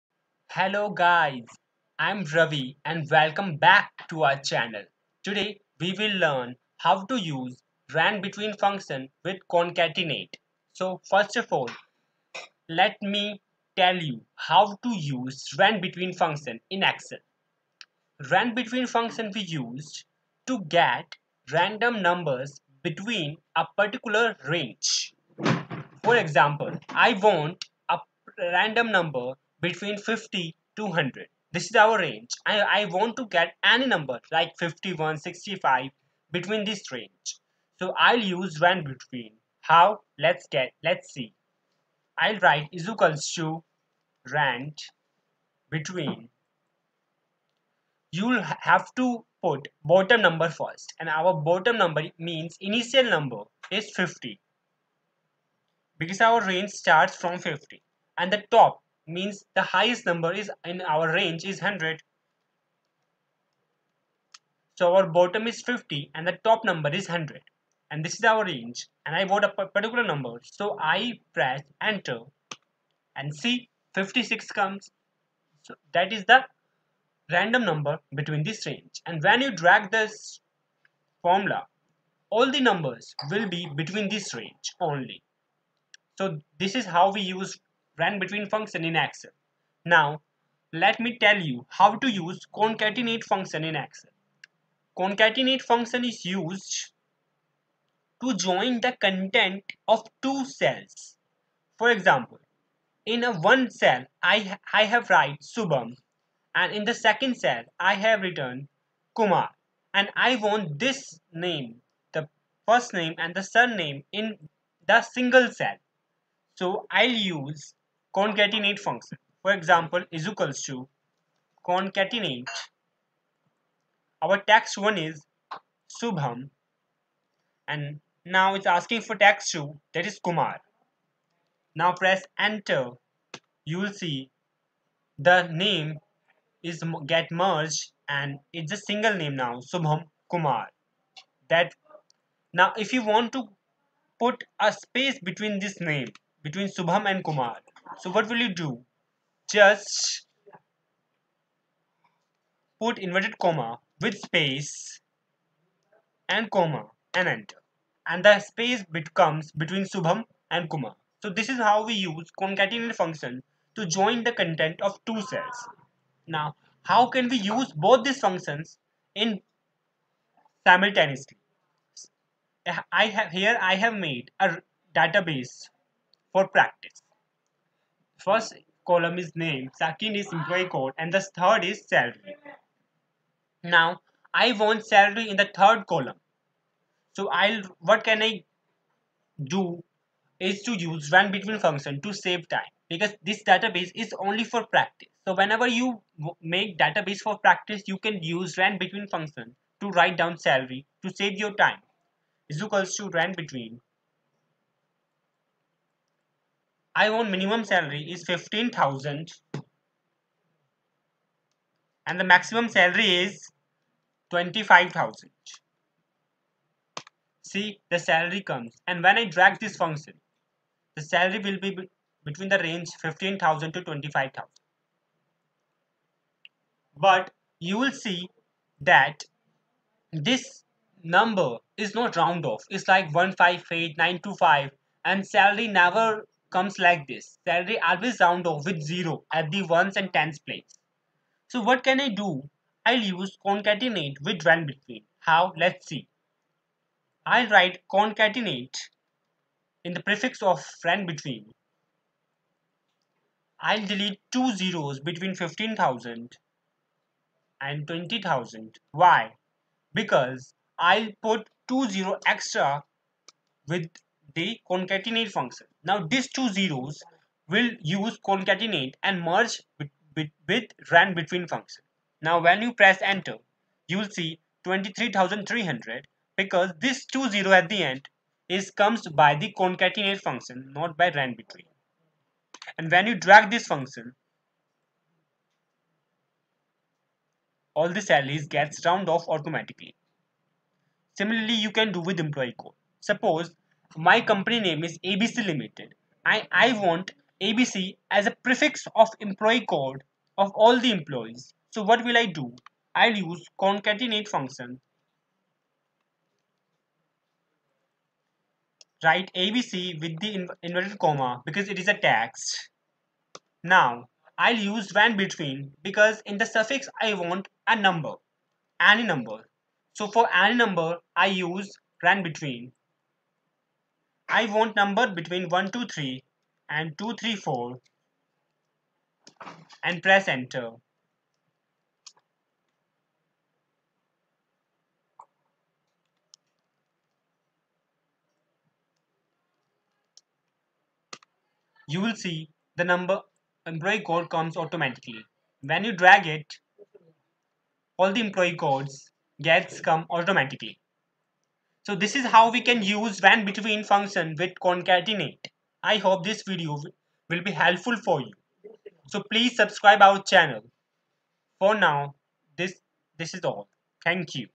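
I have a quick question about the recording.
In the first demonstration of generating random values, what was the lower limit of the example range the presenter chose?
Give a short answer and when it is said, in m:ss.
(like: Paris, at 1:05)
50, at 0:52.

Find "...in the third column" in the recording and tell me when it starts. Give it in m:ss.
3:05.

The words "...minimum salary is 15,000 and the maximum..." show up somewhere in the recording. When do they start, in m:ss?
3:27.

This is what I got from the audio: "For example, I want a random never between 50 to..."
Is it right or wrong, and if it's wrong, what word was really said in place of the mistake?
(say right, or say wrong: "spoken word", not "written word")
wrong: "number", not "never".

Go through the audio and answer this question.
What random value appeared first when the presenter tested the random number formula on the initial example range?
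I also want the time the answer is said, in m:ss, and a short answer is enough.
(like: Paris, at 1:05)
56, at 1:13.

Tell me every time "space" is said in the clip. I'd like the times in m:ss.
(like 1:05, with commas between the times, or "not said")
2:24, 2:34, 2:38.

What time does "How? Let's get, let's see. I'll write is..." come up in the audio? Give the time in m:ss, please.
0:39.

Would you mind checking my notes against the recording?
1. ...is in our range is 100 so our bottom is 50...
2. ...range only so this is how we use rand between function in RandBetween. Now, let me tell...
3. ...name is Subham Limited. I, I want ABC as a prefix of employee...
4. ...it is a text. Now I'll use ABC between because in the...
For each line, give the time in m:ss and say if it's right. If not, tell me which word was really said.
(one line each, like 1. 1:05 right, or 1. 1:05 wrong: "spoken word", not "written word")
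1. 1:00 right
2. 1:24 wrong: "Excel", not "RandBetween"
3. 4:54 wrong: "ABC", not "Subham"
4. 5:11 wrong: "RandBetween", not "ABC".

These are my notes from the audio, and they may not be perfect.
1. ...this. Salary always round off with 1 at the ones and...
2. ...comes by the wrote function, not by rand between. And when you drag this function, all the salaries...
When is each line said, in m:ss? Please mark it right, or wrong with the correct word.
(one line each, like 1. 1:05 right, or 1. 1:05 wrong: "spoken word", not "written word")
1. 3:57 wrong: "0", not "1"
2. 4:38 wrong: "concatenate", not "wrote".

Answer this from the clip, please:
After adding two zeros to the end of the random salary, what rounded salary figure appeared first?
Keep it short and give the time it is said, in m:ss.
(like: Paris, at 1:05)
23,300, at 4:34.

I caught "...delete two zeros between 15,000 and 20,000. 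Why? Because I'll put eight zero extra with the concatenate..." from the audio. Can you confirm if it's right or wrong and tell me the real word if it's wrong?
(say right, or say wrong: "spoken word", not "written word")
wrong: "two", not "eight".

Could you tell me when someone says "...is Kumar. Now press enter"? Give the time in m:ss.
2:10.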